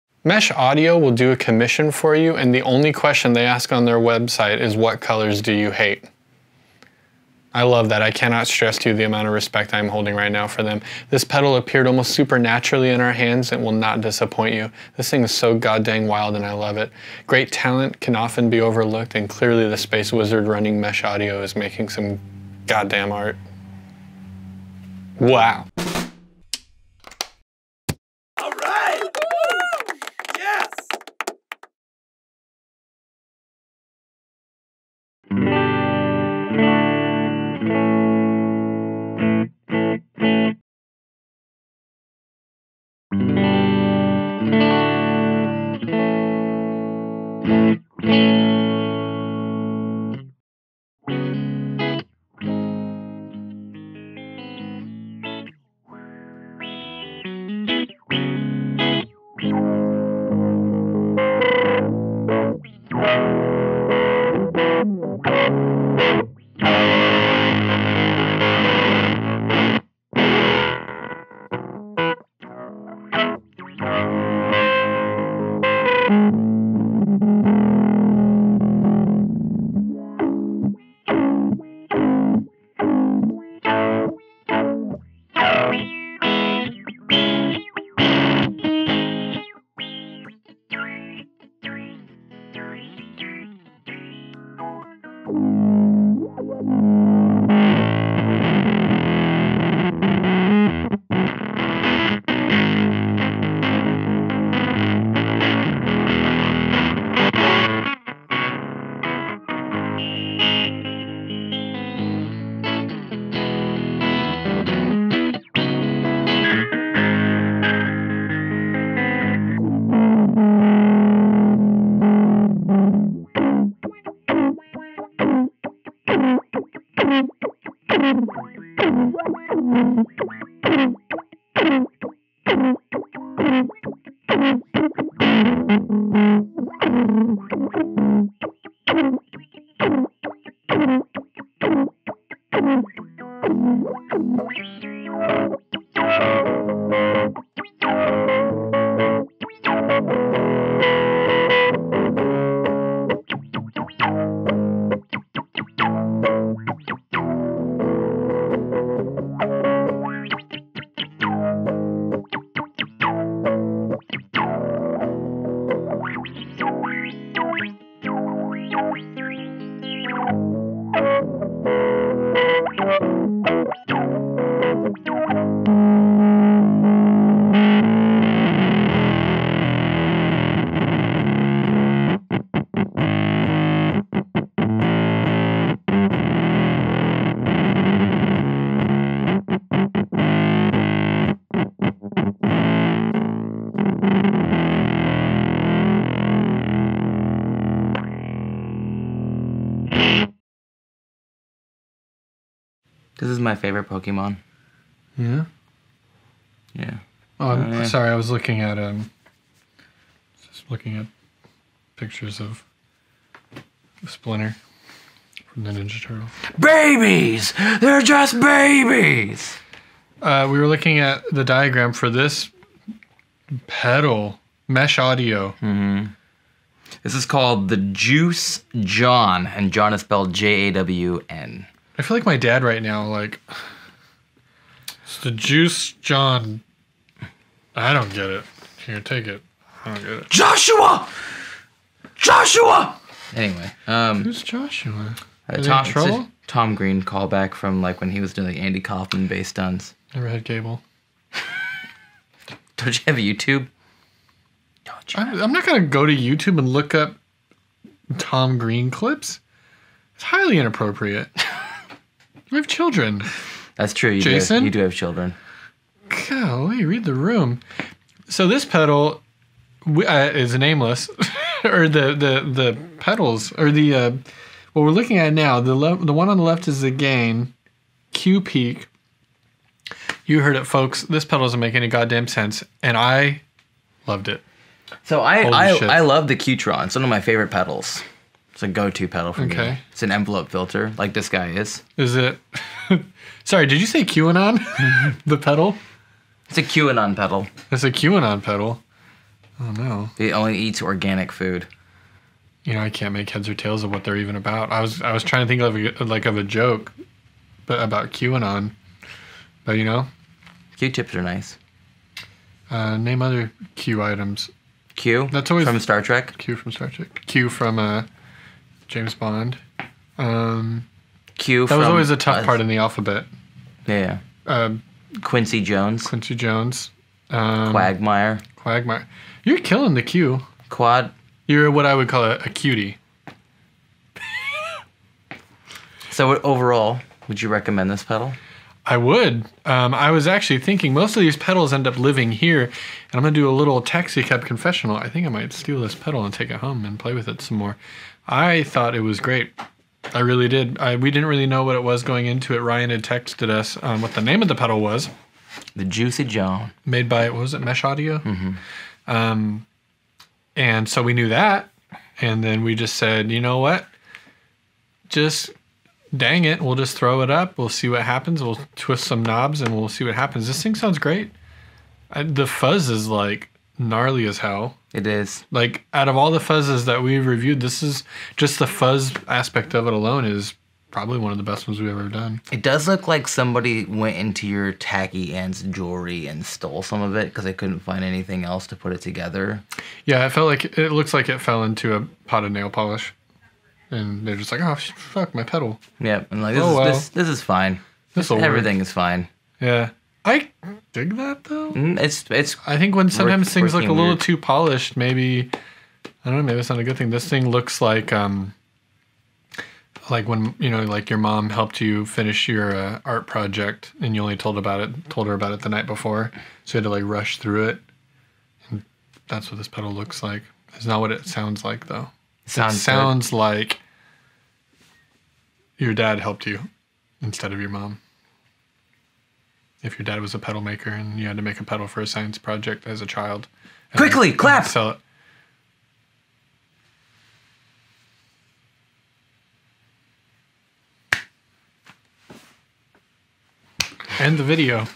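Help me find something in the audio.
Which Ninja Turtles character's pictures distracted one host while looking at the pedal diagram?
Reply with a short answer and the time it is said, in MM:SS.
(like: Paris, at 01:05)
Splinter, at 03:34.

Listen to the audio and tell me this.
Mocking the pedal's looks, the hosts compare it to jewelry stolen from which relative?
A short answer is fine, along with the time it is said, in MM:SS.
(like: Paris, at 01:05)
tacky aunt, at 06:24.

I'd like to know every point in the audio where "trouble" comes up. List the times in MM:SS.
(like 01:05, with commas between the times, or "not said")
04:05.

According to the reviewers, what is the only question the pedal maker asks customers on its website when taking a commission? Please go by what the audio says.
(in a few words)
What colors do you hate?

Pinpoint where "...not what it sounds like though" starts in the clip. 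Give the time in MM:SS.
07:00.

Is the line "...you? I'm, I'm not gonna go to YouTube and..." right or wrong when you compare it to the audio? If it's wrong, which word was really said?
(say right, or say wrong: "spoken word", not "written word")
right.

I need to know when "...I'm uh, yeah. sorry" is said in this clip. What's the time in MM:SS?
03:27.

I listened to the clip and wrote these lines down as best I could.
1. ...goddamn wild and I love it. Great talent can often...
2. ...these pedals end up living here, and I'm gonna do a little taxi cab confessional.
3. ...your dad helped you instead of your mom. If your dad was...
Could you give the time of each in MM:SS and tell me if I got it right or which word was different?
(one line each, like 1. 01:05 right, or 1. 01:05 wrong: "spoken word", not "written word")
1. 00:15 right
2. 05:41 right
3. 07:05 right.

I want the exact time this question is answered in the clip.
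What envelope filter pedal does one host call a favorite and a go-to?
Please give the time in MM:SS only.
04:46.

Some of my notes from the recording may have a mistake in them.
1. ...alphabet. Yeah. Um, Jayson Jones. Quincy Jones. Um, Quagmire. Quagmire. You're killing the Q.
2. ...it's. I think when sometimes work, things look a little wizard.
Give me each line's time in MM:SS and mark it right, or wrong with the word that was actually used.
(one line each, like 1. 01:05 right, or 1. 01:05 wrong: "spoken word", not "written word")
1. 05:22 wrong: "Quincy", not "Jayson"
2. 06:42 wrong: "weird", not "wizard".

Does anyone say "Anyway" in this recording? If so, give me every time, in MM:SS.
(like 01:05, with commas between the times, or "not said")
04:03.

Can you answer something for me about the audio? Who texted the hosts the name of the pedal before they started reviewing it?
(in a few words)
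Ryan.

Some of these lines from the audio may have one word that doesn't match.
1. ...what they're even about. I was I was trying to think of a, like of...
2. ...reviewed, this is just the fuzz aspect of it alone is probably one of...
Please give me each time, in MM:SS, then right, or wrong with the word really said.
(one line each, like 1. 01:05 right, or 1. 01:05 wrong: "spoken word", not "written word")
1. 05:03 right
2. 06:17 right.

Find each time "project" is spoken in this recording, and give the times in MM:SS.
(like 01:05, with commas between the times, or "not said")
06:53, 07:12.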